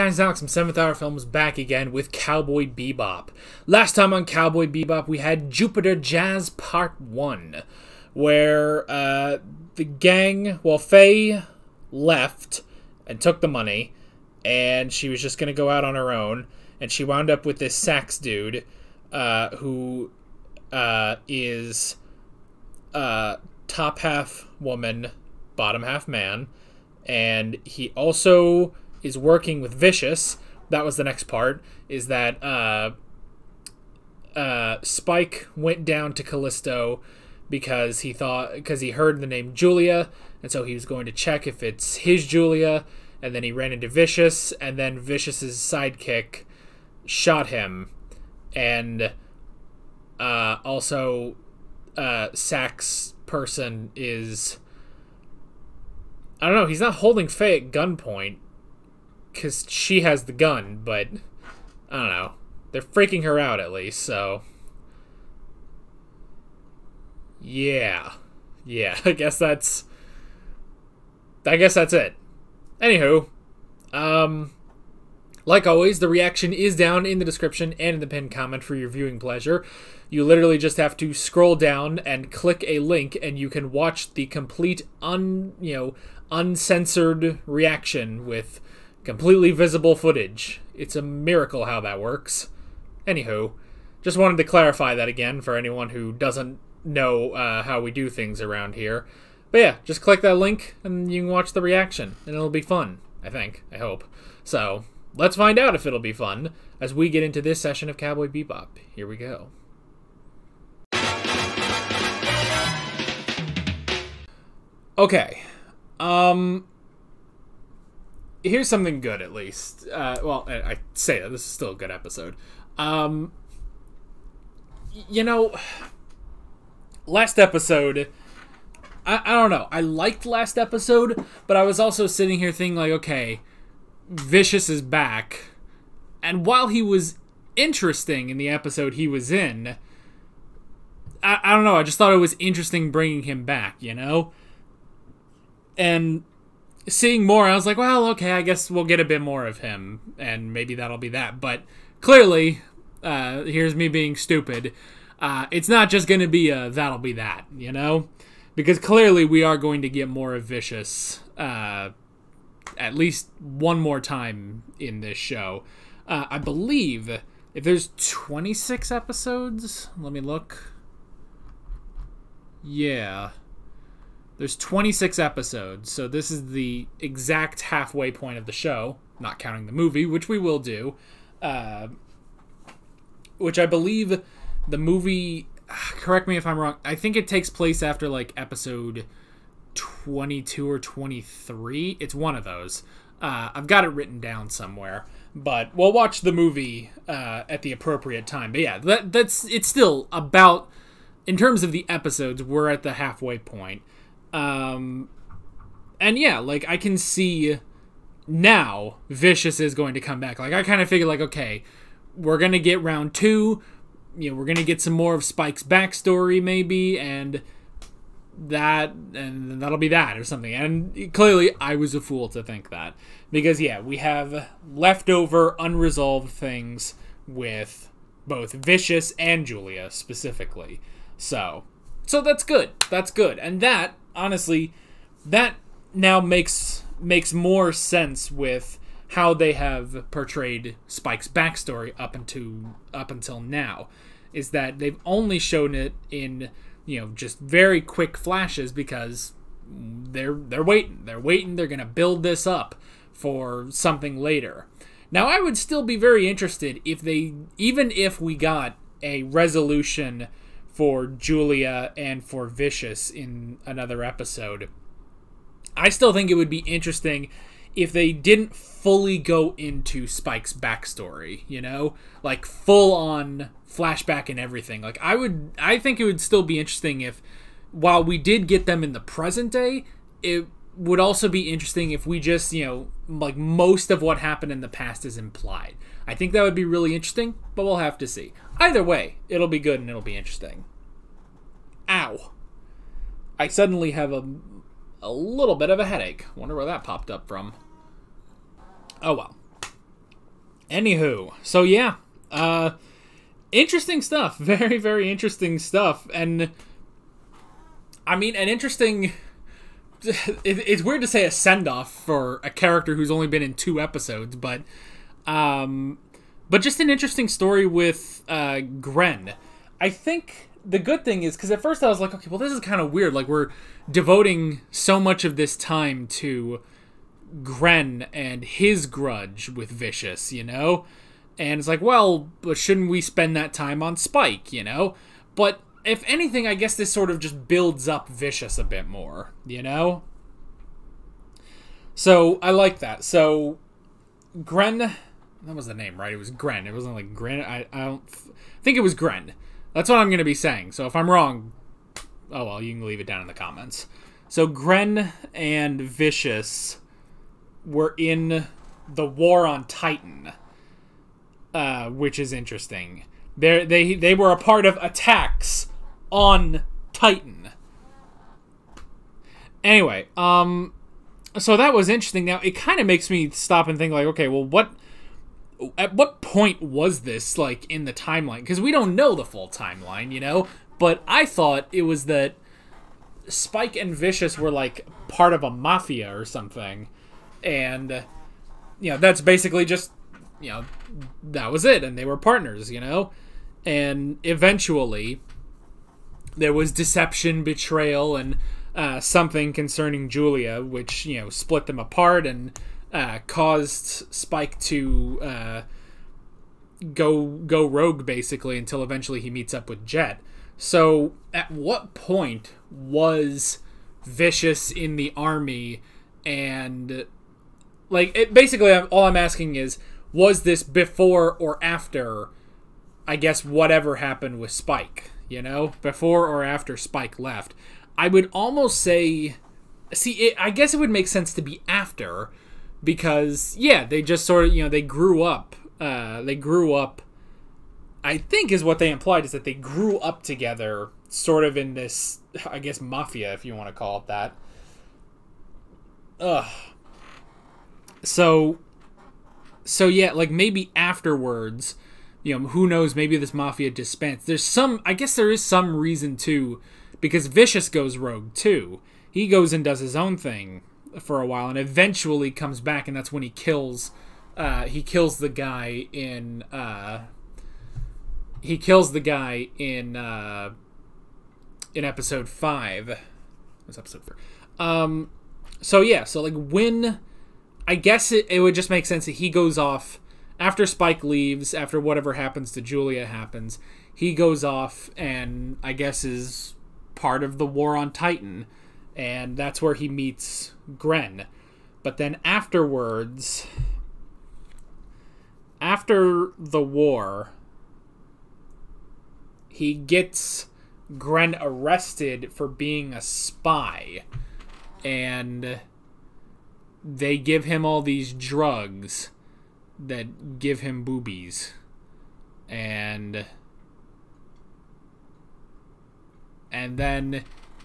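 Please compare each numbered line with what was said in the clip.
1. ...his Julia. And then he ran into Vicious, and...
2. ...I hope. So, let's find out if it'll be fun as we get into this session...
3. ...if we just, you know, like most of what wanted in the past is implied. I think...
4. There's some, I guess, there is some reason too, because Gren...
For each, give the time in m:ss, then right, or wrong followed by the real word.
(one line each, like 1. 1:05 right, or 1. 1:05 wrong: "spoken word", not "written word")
1. 0:41 right
2. 1:43 right
3. 4:41 wrong: "happened", not "wanted"
4. 7:34 wrong: "Vicious", not "Gren".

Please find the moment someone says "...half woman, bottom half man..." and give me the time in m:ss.
0:23.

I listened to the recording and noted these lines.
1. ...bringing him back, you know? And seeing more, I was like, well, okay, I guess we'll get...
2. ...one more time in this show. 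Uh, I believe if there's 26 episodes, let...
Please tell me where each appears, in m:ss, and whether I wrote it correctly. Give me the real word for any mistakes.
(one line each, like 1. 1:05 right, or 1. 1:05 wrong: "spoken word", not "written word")
1. 2:22 right
2. 2:43 right.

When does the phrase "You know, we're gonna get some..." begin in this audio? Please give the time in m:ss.
3:34.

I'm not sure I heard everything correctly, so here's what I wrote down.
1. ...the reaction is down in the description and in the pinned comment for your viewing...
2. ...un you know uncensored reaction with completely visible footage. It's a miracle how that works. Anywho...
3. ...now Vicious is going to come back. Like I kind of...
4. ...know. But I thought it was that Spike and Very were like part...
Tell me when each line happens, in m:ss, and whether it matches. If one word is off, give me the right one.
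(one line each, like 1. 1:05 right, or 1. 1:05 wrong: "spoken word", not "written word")
1. 1:15 right
2. 1:25 right
3. 3:28 right
4. 6:20 wrong: "Vicious", not "Very".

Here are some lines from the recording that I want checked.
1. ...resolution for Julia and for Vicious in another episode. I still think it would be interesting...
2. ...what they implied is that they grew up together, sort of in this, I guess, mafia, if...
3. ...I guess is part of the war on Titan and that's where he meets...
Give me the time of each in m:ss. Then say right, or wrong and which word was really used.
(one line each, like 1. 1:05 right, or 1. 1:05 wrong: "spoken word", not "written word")
1. 4:19 right
2. 7:18 right
3. 8:05 right.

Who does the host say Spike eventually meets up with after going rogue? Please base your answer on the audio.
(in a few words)
Jet.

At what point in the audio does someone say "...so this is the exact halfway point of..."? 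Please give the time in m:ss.
2:55.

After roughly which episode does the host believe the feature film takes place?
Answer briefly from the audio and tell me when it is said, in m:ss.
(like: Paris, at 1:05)
22 or 23, at 3:08.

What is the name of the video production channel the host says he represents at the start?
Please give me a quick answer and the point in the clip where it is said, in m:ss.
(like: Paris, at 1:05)
7th Hour Films, at 0:00.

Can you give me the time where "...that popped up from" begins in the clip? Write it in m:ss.
4:56.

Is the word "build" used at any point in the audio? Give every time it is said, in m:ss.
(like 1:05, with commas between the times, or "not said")
4:11, 5:37.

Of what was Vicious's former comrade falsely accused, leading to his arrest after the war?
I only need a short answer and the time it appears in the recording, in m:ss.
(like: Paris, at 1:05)
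Being a spy, at 8:22.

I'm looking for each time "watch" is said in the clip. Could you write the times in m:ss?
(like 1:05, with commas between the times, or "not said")
1:23, 1:41, 3:15.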